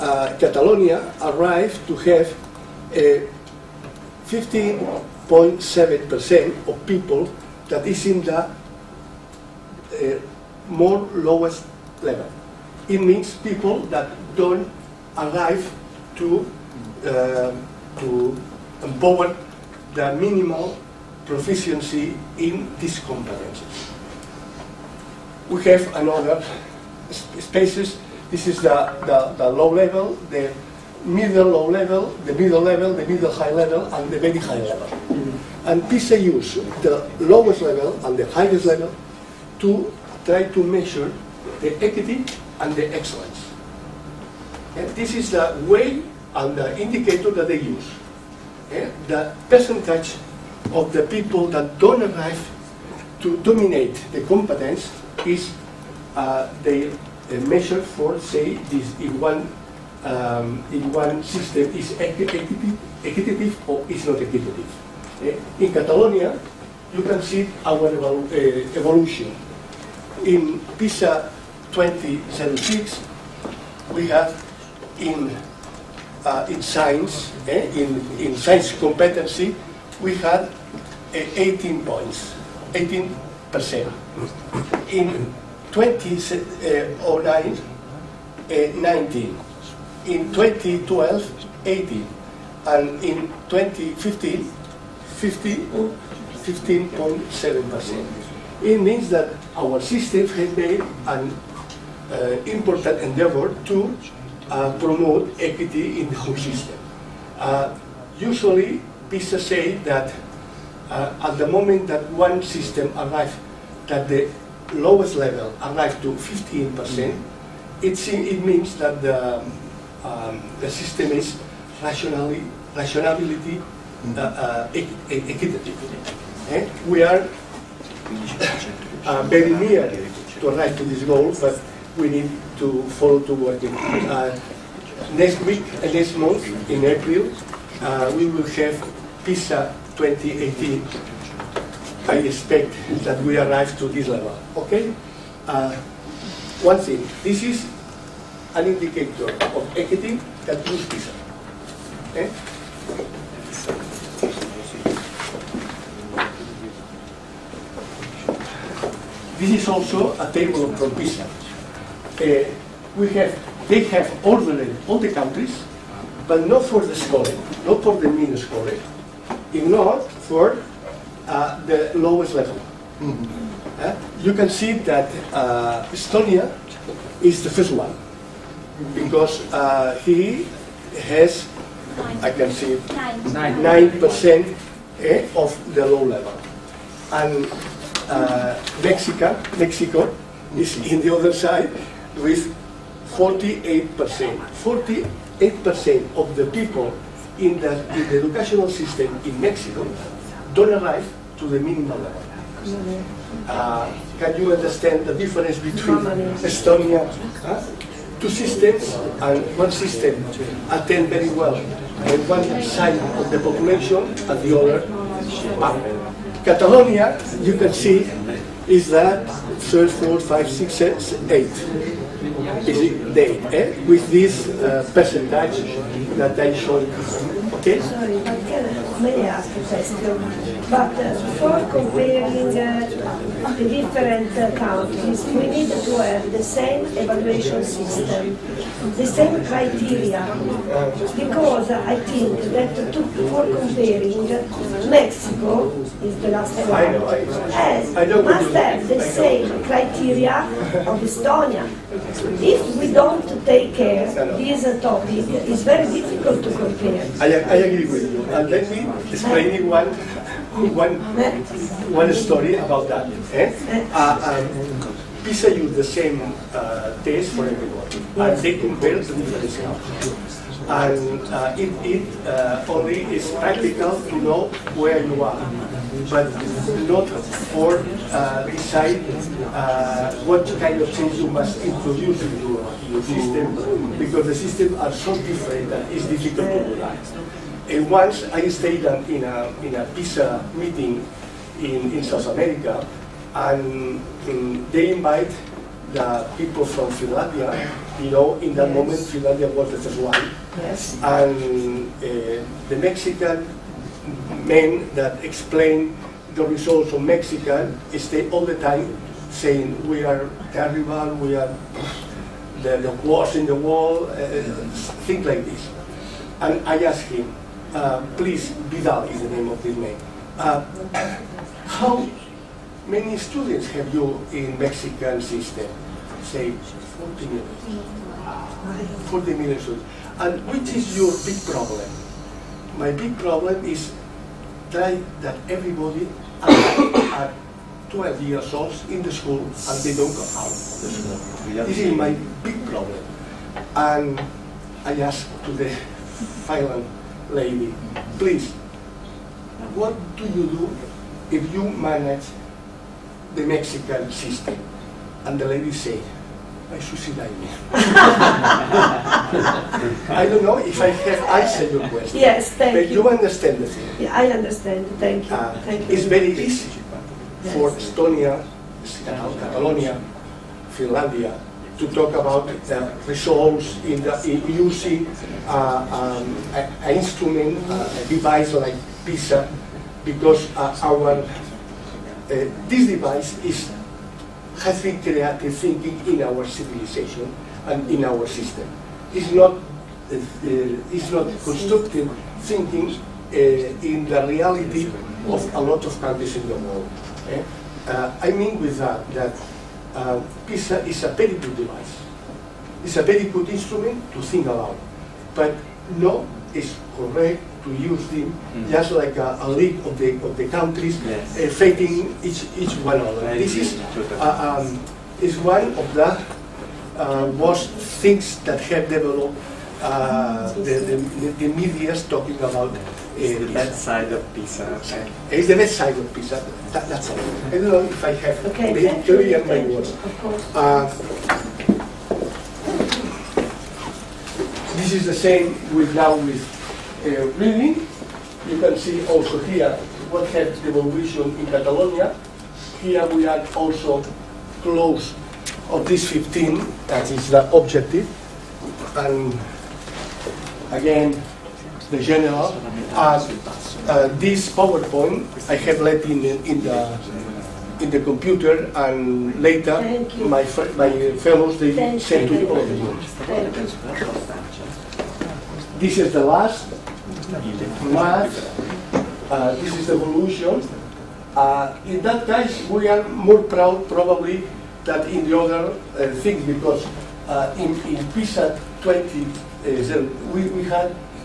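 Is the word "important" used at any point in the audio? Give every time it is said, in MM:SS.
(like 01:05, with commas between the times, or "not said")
01:42.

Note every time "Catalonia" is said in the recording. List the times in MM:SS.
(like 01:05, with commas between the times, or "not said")
00:00, 01:05, 03:36, 06:09, 07:21.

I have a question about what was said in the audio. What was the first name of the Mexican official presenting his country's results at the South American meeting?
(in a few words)
Vidal.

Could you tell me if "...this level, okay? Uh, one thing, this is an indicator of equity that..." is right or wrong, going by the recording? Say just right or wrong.
right.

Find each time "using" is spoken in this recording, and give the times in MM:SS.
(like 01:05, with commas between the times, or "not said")
06:14.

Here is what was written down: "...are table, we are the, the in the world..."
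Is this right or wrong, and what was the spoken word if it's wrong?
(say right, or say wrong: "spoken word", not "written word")
wrong: "terrible", not "table".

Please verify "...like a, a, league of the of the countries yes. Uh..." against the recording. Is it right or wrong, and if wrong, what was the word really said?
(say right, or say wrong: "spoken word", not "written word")
right.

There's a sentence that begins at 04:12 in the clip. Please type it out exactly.
If we don't take care this topic, it's very difficult to compare.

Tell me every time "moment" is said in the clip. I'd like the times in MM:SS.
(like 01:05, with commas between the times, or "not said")
01:51, 04:58.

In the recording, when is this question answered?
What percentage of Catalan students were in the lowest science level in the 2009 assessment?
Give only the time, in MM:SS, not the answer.
01:28.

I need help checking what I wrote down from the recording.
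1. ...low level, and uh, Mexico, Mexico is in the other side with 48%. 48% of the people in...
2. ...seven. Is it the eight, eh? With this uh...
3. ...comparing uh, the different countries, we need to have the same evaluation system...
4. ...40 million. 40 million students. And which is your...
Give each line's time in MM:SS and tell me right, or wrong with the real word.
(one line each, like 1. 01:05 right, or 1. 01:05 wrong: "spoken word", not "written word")
1. 03:05 right
2. 03:40 wrong: "eight", not "seven"
3. 03:51 right
4. 05:26 right.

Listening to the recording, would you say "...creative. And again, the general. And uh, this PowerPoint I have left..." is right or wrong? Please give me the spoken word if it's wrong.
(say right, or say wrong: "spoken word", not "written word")
wrong: "objective", not "creative".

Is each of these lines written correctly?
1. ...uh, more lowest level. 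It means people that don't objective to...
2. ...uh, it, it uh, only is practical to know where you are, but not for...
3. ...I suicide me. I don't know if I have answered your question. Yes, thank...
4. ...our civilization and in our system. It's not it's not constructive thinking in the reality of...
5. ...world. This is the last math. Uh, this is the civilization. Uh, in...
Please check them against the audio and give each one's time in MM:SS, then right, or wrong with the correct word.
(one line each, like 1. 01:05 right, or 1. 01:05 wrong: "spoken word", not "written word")
1. 00:08 wrong: "arrive", not "objective"
2. 04:31 right
3. 05:56 right
4. 06:26 right
5. 07:42 wrong: "evolution", not "civilization".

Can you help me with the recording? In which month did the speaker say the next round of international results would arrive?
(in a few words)
April.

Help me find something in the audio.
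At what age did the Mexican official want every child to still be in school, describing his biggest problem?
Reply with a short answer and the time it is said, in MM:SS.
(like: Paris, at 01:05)
12, at 05:37.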